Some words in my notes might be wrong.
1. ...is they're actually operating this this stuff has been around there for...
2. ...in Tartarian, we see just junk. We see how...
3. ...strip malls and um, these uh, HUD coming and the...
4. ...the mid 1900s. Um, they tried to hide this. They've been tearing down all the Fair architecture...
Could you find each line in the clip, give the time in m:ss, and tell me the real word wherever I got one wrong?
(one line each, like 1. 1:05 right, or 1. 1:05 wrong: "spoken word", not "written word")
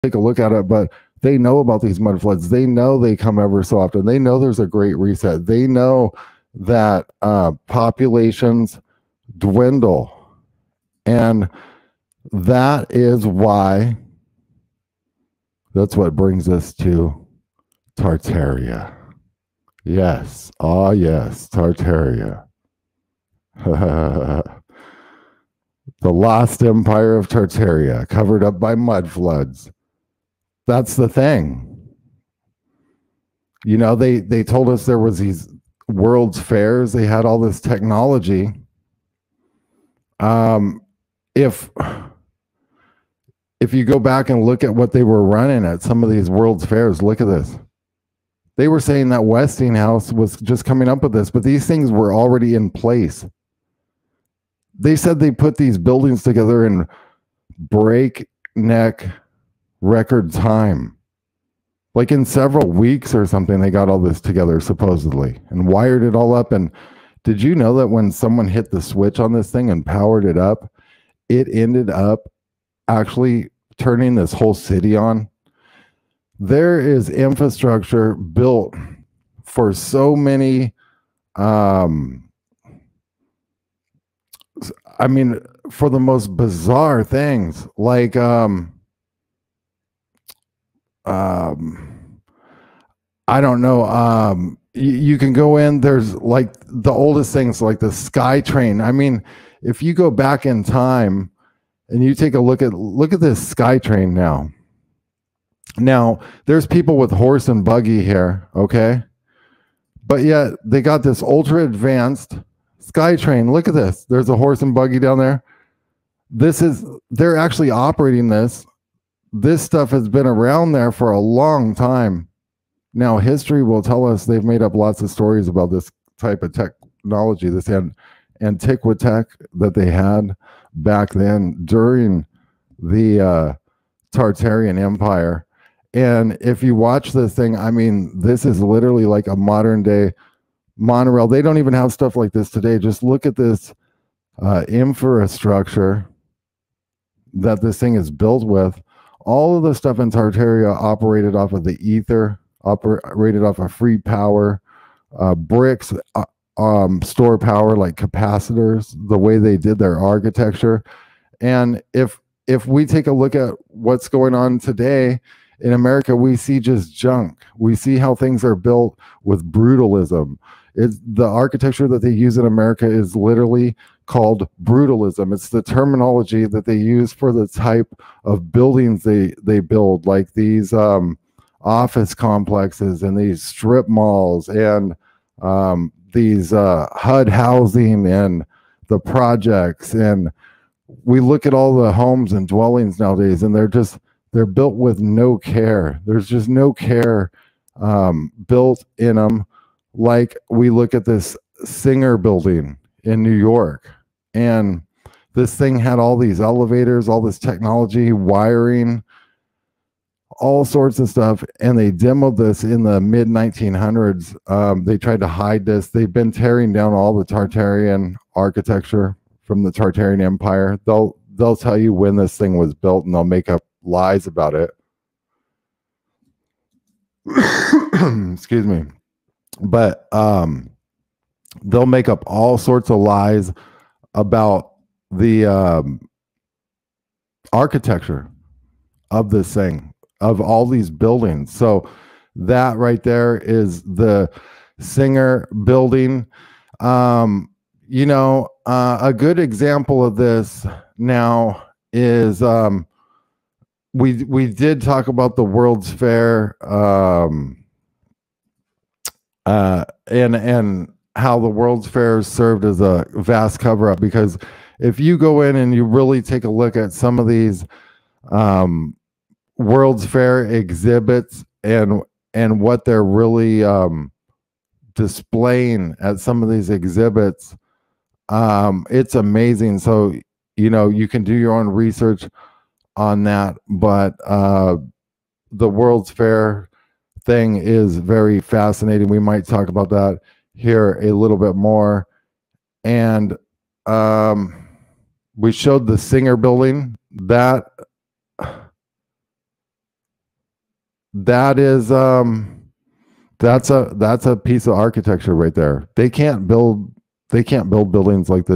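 1. 1:56 right
2. 2:45 wrong: "America", not "Tartarian"
3. 3:03 wrong: "housing", not "coming"
4. 3:32 wrong: "Tartarian", not "Fair".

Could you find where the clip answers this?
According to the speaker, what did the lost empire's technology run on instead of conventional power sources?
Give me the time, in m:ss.
2:31.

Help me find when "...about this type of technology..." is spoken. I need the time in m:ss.
2:05.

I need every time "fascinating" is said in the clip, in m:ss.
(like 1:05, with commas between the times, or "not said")
4:48.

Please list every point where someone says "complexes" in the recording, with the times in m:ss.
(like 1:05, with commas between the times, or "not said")
3:02.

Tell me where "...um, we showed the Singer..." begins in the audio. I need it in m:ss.
4:53.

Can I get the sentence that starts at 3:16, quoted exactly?
There's just no care um, built in them.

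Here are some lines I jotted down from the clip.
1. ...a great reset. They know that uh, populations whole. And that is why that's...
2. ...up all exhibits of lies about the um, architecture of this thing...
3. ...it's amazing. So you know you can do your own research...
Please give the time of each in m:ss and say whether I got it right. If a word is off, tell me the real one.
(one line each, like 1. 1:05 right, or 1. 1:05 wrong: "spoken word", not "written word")
1. 0:04 wrong: "dwindle", not "whole"
2. 3:52 wrong: "sorts", not "exhibits"
3. 4:38 right.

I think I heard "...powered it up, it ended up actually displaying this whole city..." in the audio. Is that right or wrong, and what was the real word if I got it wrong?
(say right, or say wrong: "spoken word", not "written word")
wrong: "turning", not "displaying".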